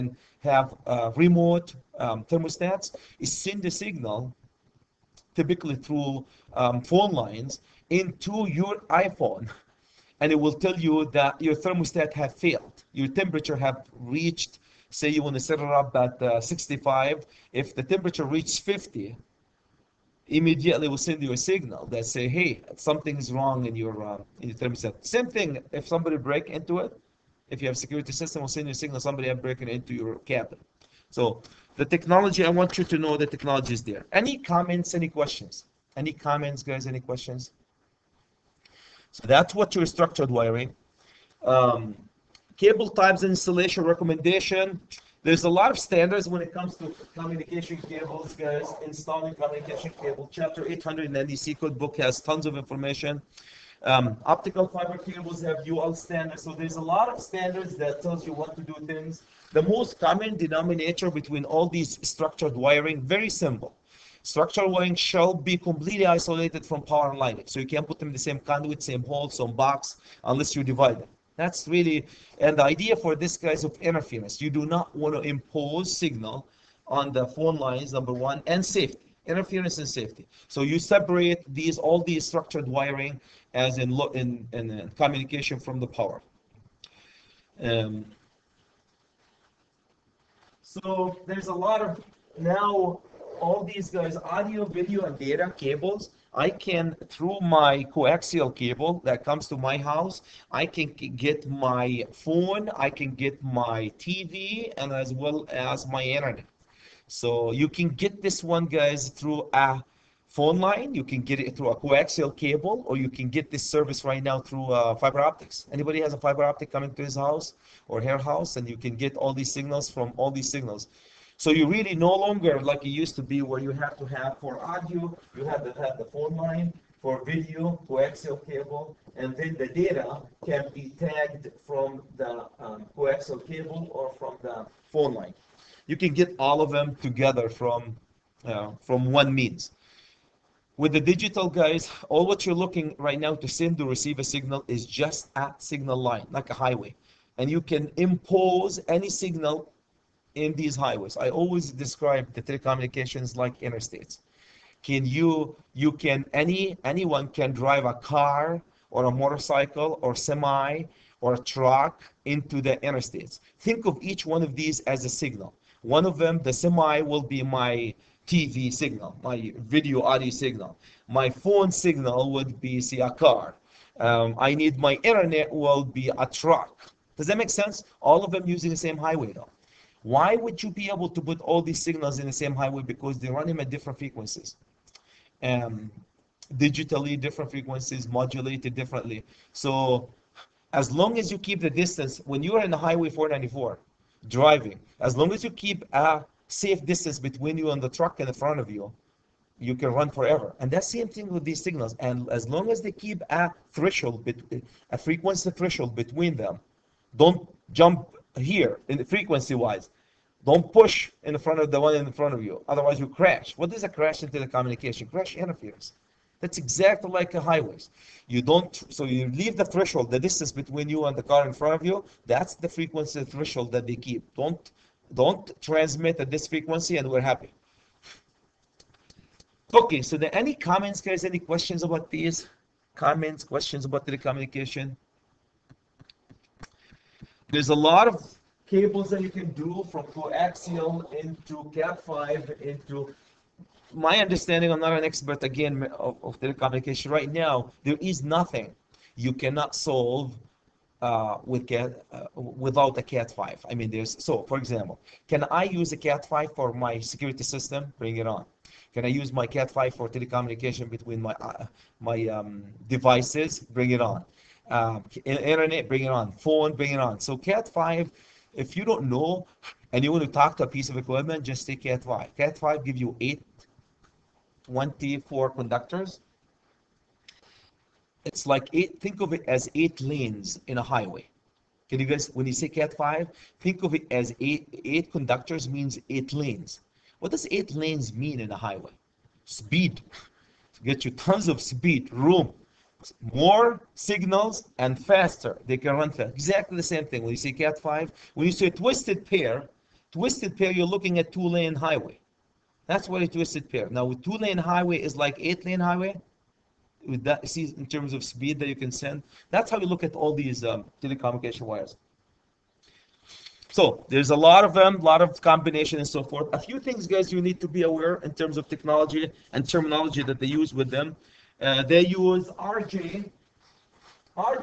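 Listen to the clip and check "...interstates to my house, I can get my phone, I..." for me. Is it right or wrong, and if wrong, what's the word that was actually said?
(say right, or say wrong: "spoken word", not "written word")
wrong: "comes", not "interstates".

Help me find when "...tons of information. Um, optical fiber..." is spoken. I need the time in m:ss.
0:52.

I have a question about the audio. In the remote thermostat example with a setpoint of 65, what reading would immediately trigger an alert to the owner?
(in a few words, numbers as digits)
50.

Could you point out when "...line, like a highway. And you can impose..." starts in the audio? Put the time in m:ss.
2:25.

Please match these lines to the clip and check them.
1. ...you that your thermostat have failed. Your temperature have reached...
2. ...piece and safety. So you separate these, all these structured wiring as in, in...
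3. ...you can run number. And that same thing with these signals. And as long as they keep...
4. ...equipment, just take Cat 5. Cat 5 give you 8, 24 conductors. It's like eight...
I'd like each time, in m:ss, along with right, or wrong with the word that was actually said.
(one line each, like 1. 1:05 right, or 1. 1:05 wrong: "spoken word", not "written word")
1. 0:10 right
2. 1:19 wrong: "interference", not "piece"
3. 3:19 wrong: "forever", not "number"
4. 4:30 right.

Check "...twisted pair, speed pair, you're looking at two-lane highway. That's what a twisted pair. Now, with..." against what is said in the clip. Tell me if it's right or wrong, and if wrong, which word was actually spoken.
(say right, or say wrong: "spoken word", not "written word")
wrong: "twisted", not "speed".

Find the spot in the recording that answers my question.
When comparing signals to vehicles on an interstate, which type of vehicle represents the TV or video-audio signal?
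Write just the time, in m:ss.
2:46.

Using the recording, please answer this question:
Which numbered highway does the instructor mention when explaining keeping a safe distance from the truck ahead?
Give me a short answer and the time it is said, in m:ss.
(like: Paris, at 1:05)
494, at 3:13.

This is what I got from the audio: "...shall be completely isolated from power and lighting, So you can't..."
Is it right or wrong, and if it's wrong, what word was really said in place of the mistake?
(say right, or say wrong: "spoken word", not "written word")
right.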